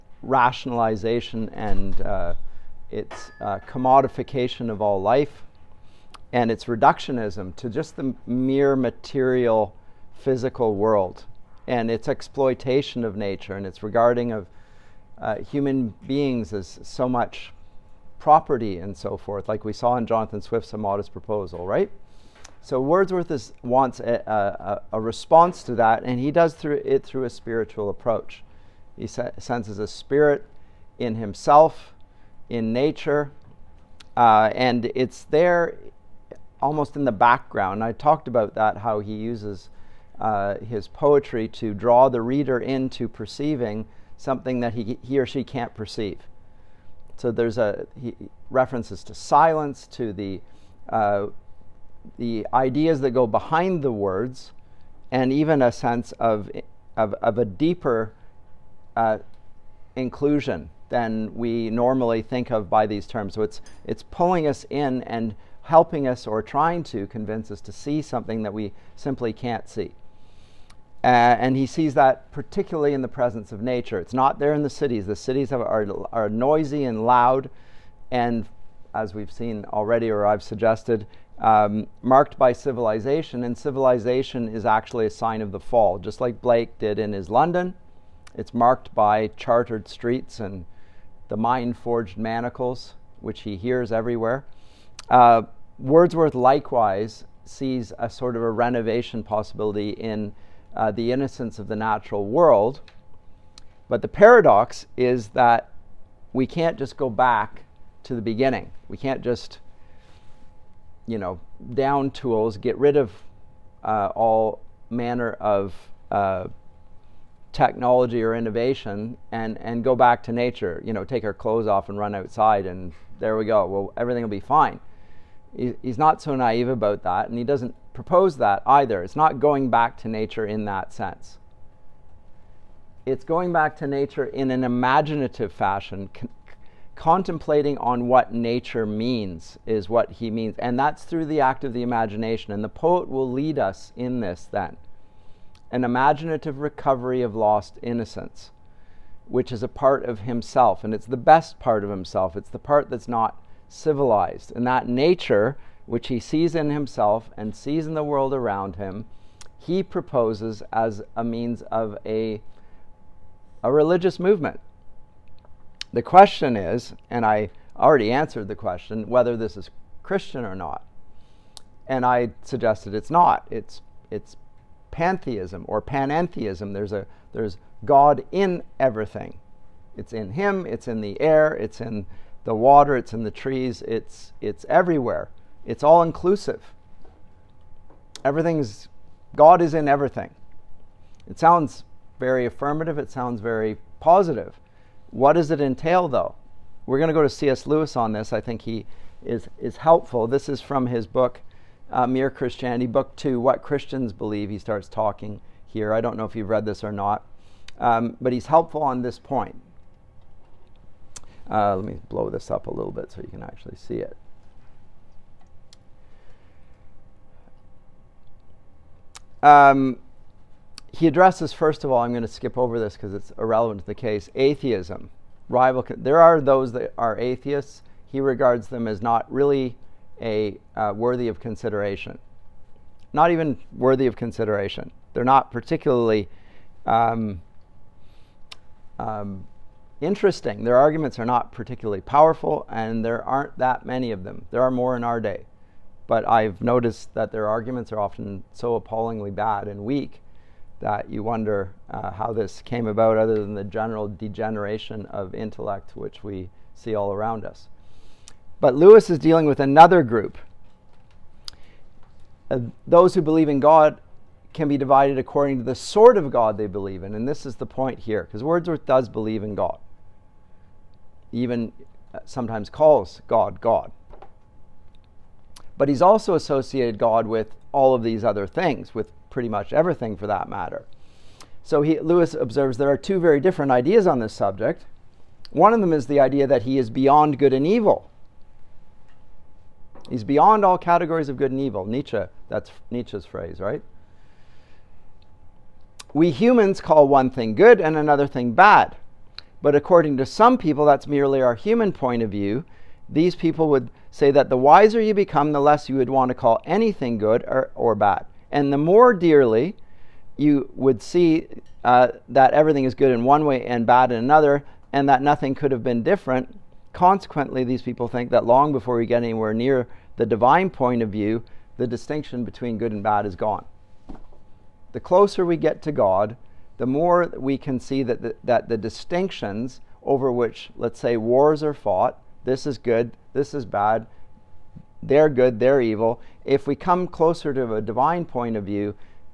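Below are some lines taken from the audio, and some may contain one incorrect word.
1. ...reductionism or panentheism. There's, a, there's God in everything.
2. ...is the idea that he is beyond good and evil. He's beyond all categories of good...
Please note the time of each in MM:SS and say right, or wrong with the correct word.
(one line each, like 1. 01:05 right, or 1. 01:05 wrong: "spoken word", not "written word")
1. 02:54 wrong: "pantheism", not "reductionism"
2. 04:45 right.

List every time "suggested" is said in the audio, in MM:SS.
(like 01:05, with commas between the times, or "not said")
01:20, 02:52.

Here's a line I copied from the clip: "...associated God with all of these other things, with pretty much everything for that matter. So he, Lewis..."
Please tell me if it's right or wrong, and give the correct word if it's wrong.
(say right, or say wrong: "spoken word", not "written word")
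right.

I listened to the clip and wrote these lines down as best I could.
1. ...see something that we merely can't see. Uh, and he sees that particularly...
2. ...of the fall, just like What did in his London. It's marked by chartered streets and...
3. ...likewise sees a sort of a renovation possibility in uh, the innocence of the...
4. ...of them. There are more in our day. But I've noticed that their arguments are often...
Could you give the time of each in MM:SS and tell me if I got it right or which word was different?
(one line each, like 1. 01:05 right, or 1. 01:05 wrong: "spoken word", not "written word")
1. 01:07 wrong: "simply", not "merely"
2. 01:25 wrong: "Blake", not "What"
3. 01:36 right
4. 04:04 right.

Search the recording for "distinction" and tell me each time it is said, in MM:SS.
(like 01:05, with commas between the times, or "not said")
05:21, 05:28.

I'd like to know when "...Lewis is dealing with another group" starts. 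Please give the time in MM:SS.
04:18.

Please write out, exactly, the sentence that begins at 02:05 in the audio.
He, he's not so naive about that and he doesn't propose that either.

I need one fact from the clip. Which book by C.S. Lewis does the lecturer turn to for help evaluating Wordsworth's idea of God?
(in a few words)
Mere Christianity.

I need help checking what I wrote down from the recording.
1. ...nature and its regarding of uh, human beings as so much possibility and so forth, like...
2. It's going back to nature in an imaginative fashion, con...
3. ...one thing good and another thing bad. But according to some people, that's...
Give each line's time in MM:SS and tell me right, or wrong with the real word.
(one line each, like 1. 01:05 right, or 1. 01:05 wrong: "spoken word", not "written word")
1. 00:13 wrong: "property", not "possibility"
2. 02:13 right
3. 04:57 right.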